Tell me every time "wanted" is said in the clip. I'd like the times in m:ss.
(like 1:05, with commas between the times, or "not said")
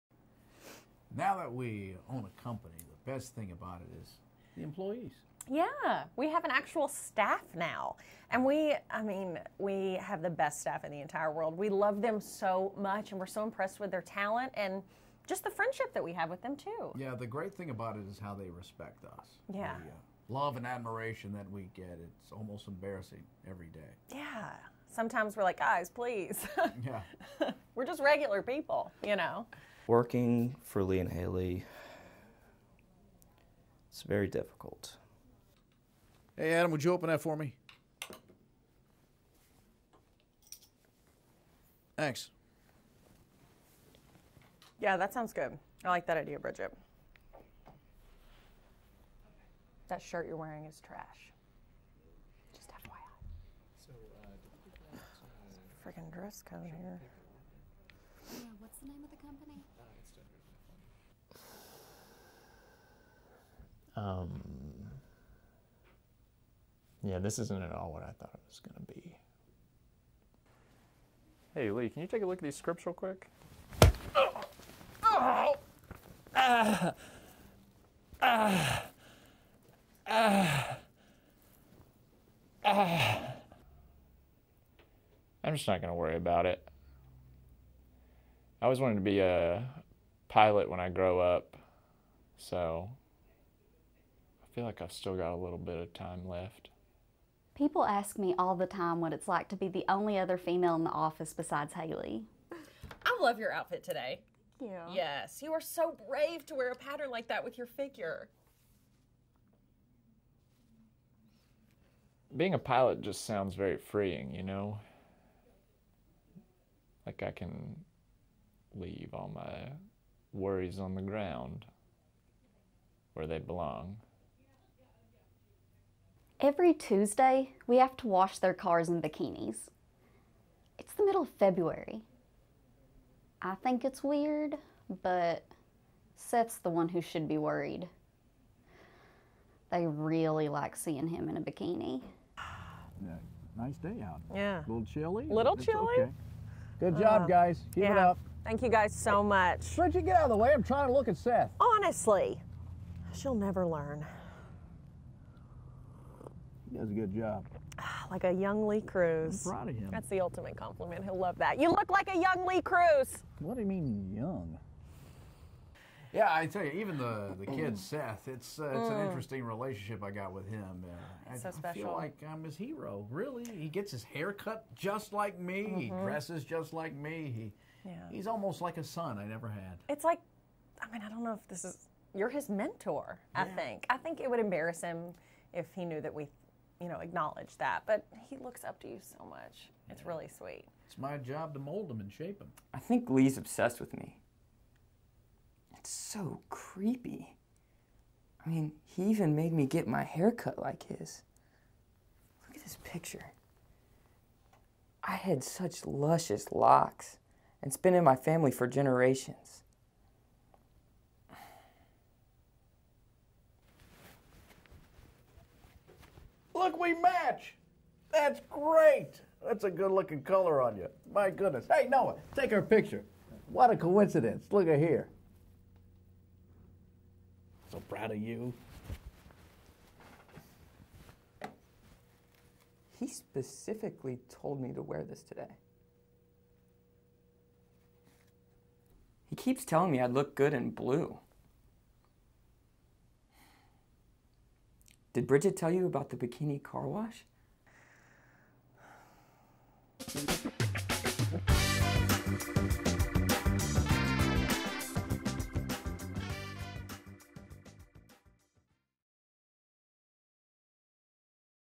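1:28.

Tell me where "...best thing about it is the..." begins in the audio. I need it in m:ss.
0:03.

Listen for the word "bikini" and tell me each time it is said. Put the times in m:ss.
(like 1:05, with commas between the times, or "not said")
2:08, 2:21, 4:06.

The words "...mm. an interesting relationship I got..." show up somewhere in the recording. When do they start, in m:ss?
2:48.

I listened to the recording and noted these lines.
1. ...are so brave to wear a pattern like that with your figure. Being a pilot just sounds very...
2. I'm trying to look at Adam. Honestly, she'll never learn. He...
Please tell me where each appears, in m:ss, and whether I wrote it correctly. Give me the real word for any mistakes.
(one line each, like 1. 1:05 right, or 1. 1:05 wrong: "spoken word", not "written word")
1. 1:45 right
2. 2:30 wrong: "Seth", not "Adam".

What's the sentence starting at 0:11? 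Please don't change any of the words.
We love them so much and we're so impressed with their talent and just the friendship that we have with them, too.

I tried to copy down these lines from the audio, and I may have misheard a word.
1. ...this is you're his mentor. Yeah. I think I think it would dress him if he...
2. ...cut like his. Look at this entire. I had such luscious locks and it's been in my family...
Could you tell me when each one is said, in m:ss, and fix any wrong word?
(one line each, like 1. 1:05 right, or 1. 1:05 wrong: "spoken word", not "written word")
1. 3:01 wrong: "embarrass", not "dress"
2. 3:20 wrong: "picture", not "entire".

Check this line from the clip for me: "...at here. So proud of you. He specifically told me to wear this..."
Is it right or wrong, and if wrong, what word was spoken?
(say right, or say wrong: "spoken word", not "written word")
right.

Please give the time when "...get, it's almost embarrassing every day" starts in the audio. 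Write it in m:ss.
0:21.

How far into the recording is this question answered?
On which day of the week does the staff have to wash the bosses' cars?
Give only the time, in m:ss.
2:06.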